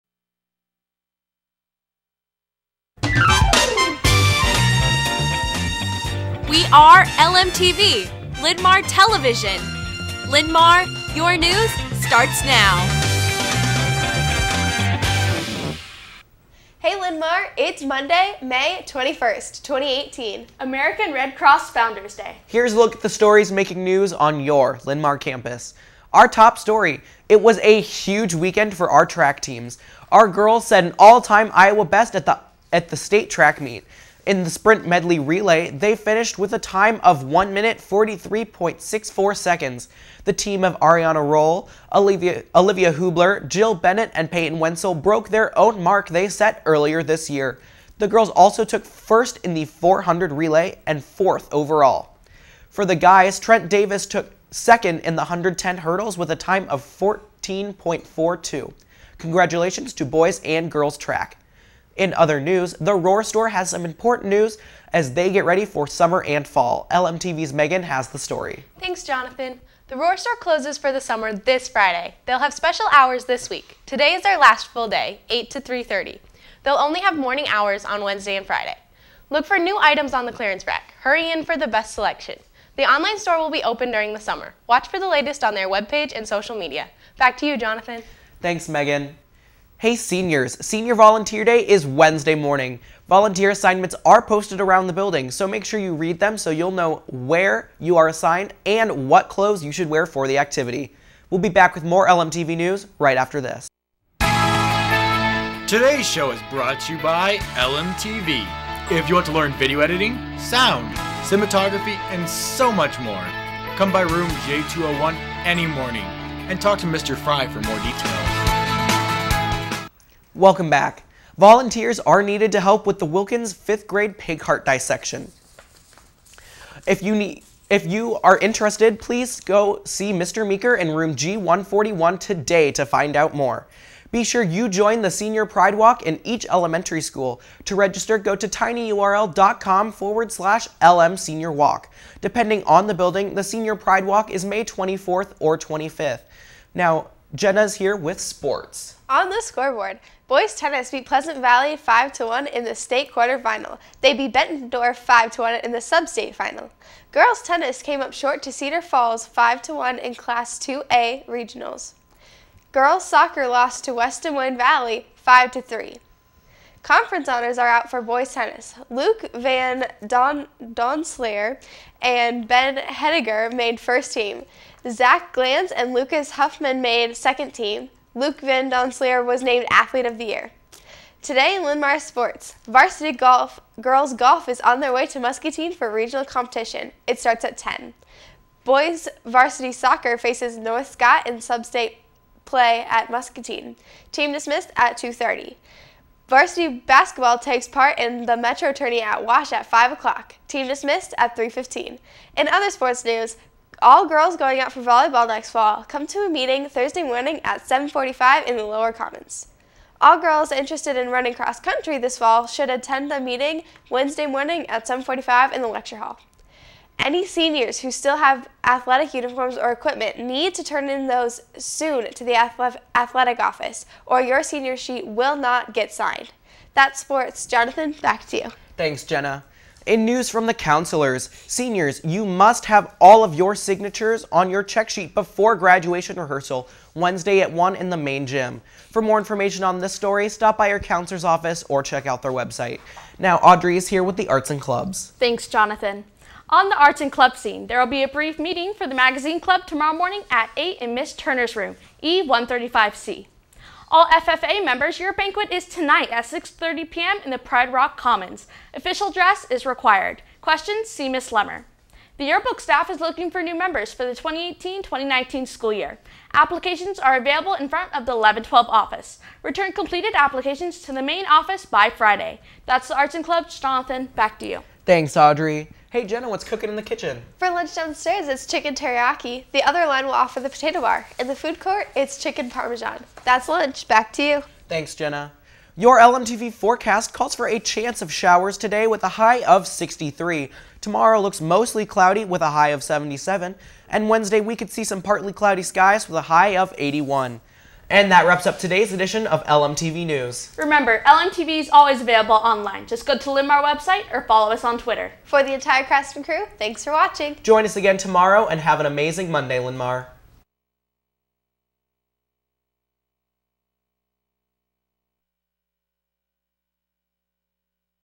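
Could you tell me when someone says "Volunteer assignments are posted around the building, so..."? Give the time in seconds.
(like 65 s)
93 s.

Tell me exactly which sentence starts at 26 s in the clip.
Our top story, it was a huge weekend for our track teams.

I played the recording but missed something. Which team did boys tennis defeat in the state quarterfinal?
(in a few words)
Pleasant Valley.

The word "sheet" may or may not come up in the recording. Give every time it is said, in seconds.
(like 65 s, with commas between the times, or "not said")
224 s, 234 s.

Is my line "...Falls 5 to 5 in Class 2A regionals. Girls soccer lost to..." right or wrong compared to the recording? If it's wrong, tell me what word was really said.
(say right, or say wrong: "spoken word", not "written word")
wrong: "1", not "5".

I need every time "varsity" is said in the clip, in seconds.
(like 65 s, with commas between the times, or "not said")
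182 s, 189 s, 196 s.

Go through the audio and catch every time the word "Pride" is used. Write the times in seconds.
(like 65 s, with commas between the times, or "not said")
135 s, 143 s, 257 s.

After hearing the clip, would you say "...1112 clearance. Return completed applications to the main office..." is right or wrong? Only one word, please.
wrong.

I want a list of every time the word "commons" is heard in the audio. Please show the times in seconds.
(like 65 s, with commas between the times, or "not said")
208 s, 257 s.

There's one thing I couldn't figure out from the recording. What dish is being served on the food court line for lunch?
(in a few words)
Chicken parmesan.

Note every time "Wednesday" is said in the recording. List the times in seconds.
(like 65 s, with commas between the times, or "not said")
78 s, 91 s, 213 s, 236 s, 294 s.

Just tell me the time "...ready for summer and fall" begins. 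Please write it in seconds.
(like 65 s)
65 s.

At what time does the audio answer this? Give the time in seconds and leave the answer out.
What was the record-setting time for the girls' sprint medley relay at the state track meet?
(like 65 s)
37 s.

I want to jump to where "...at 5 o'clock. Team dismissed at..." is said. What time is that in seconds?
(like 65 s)
199 s.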